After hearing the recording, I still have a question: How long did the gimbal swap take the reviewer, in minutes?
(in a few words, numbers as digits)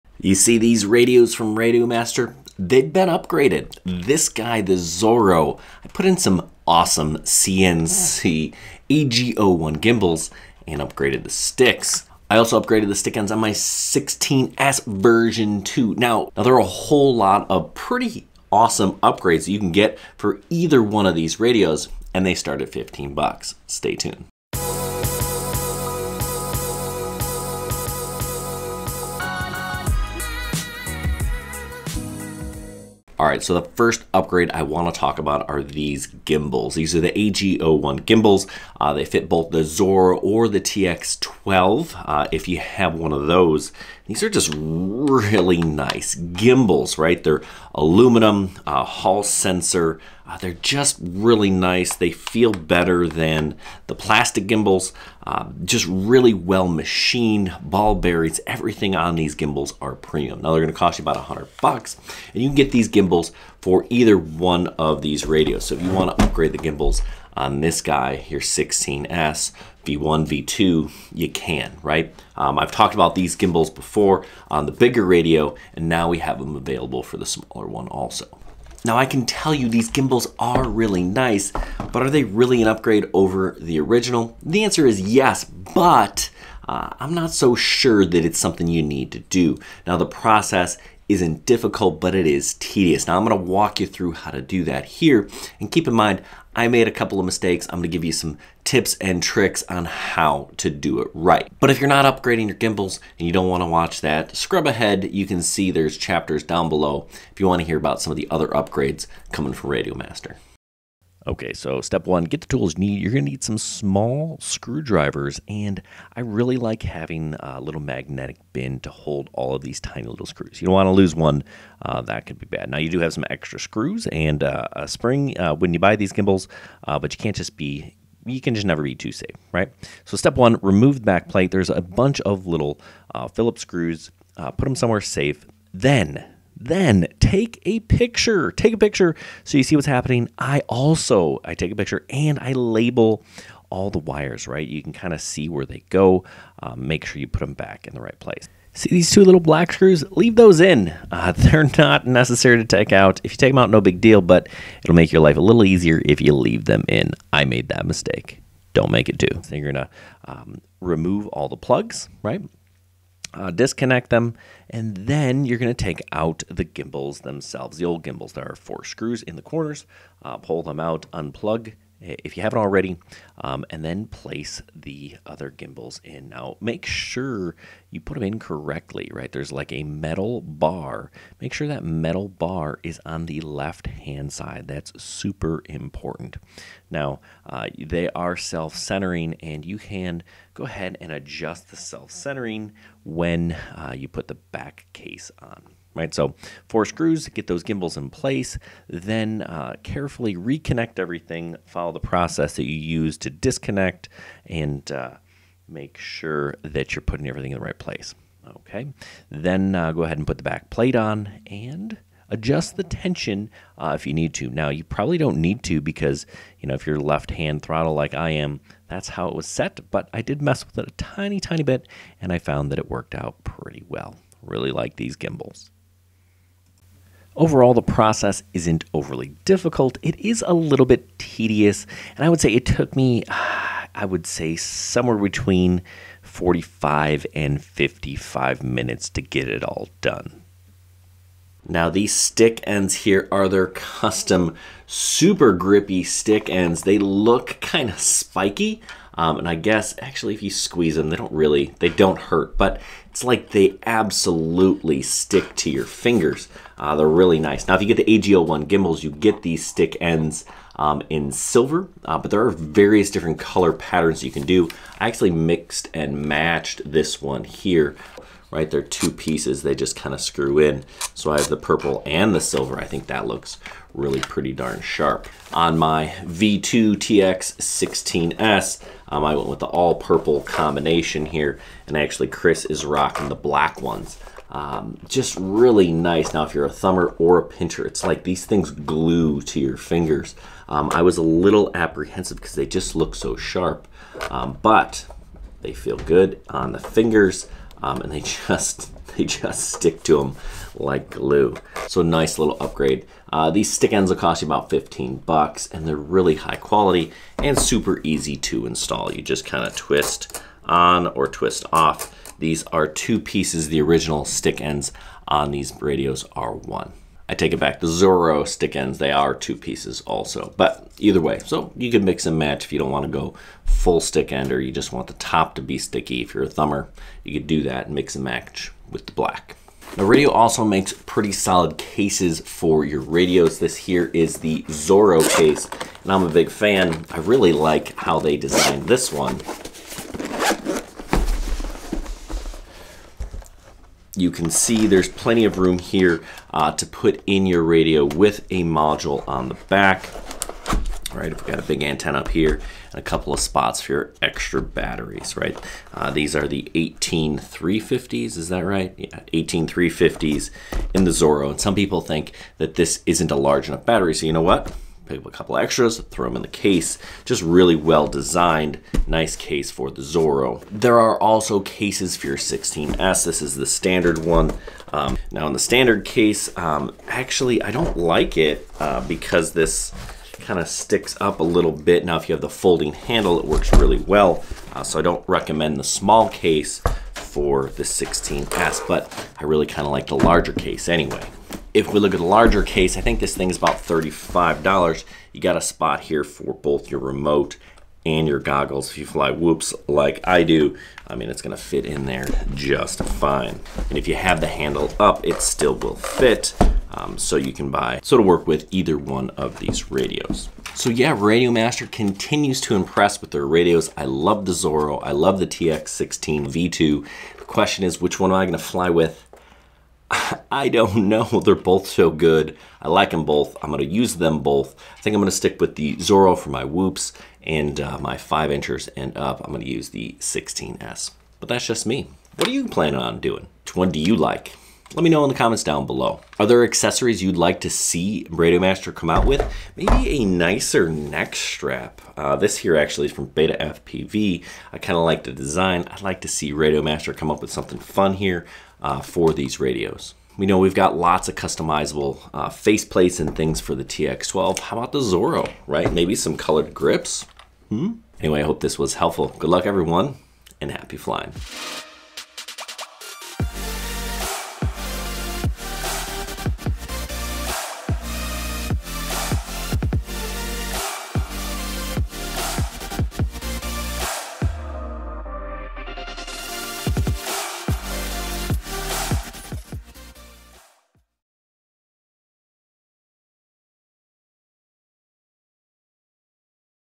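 45 to 55 minutes.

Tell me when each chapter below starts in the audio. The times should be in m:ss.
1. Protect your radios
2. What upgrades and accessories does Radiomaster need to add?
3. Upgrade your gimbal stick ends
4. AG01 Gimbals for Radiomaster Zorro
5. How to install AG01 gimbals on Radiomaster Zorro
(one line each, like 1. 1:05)
1. 5:30
2. 7:14
3. 4:01
4. 0:30
5. 1:50.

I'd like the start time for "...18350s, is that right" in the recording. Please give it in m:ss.
5:56.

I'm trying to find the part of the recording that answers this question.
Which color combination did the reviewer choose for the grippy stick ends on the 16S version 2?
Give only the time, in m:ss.
4:39.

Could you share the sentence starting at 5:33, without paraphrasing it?
This here is the Zorro case, and I'm a big fan.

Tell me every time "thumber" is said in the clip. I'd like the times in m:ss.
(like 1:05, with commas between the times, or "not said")
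4:46, 5:26.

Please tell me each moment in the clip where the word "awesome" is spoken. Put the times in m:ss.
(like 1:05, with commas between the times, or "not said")
0:06, 0:18.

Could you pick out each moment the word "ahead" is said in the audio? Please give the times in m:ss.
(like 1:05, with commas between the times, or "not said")
1:44, 3:10, 3:30.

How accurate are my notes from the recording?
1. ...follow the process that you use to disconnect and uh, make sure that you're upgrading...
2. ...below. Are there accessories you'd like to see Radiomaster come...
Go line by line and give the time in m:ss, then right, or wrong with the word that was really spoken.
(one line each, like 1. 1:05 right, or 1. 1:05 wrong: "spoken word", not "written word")
1. 3:21 wrong: "putting", not "upgrading"
2. 7:15 right.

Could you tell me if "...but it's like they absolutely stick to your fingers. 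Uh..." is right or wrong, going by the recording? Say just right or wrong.
right.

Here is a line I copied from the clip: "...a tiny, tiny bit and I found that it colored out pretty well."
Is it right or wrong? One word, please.
wrong.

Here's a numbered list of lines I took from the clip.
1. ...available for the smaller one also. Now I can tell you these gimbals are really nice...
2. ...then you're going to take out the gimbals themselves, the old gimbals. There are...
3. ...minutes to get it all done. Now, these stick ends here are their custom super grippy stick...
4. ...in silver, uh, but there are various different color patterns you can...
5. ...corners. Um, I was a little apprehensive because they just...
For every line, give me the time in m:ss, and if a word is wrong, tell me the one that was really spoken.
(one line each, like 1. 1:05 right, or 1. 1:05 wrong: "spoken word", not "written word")
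1. 1:16 right
2. 2:44 right
3. 3:58 right
4. 4:21 right
5. 4:49 wrong: "fingers", not "corners".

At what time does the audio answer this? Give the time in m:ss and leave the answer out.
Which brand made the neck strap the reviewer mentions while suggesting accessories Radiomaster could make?
7:23.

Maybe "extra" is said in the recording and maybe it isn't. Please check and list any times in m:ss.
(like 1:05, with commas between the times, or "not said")
2:03, 5:54, 6:05.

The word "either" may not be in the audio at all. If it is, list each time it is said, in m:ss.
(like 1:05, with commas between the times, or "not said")
0:20, 1:03, 5:20, 6:48.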